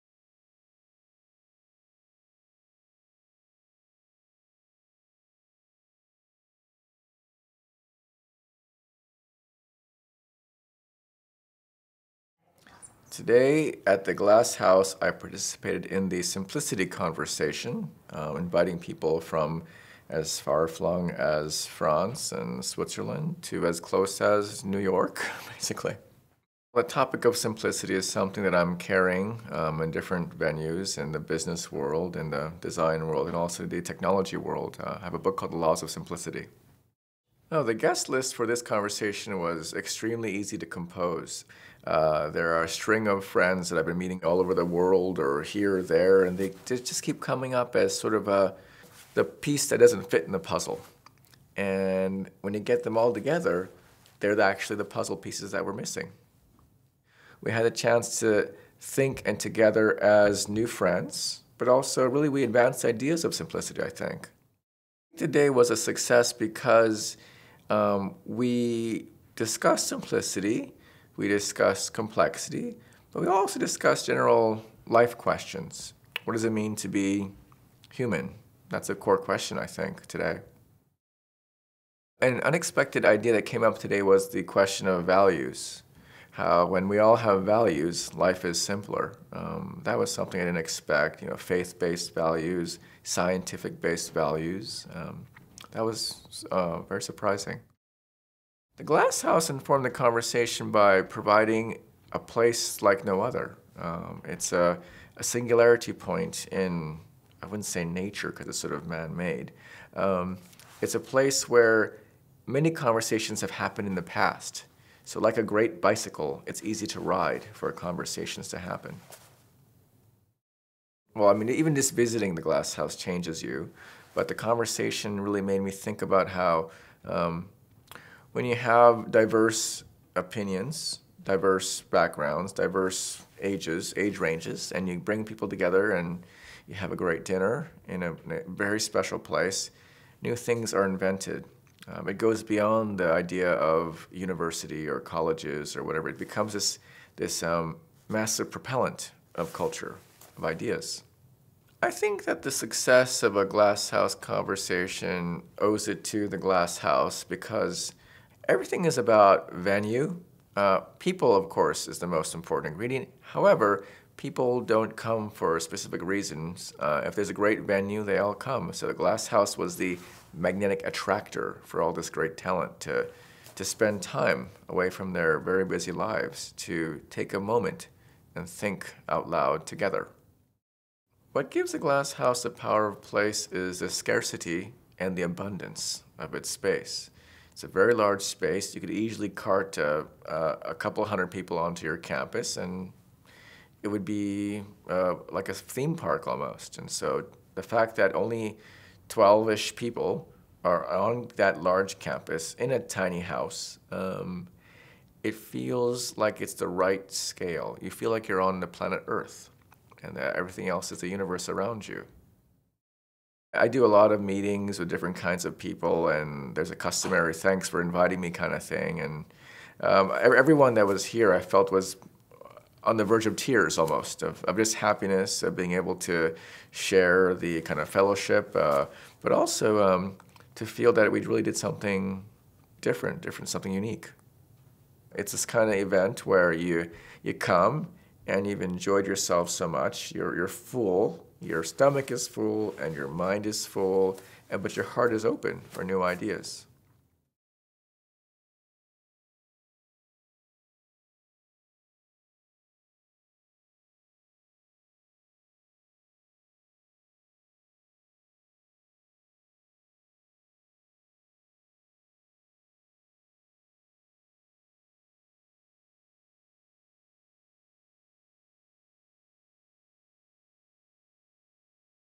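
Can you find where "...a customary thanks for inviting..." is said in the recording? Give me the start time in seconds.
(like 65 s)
216 s.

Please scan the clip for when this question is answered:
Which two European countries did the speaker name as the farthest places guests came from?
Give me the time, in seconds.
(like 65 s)
21 s.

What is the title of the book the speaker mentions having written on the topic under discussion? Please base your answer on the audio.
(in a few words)
The Laws of Simplicity.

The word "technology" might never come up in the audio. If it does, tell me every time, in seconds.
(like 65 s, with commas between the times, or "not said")
33 s.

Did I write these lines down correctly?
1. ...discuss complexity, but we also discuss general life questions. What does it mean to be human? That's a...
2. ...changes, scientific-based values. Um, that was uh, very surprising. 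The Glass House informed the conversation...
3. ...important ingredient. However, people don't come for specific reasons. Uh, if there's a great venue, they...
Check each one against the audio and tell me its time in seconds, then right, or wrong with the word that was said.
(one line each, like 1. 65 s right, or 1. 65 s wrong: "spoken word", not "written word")
1. 71 s right
2. 92 s wrong: "values", not "changes"
3. 162 s right.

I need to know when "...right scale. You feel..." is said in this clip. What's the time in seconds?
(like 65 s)
206 s.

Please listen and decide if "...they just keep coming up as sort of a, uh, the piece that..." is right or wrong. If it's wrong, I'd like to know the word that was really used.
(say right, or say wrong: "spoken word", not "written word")
right.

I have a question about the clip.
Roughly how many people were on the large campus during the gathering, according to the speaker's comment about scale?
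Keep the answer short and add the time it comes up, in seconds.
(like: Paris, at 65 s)
12, at 199 s.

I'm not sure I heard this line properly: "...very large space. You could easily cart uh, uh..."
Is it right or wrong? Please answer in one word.
right.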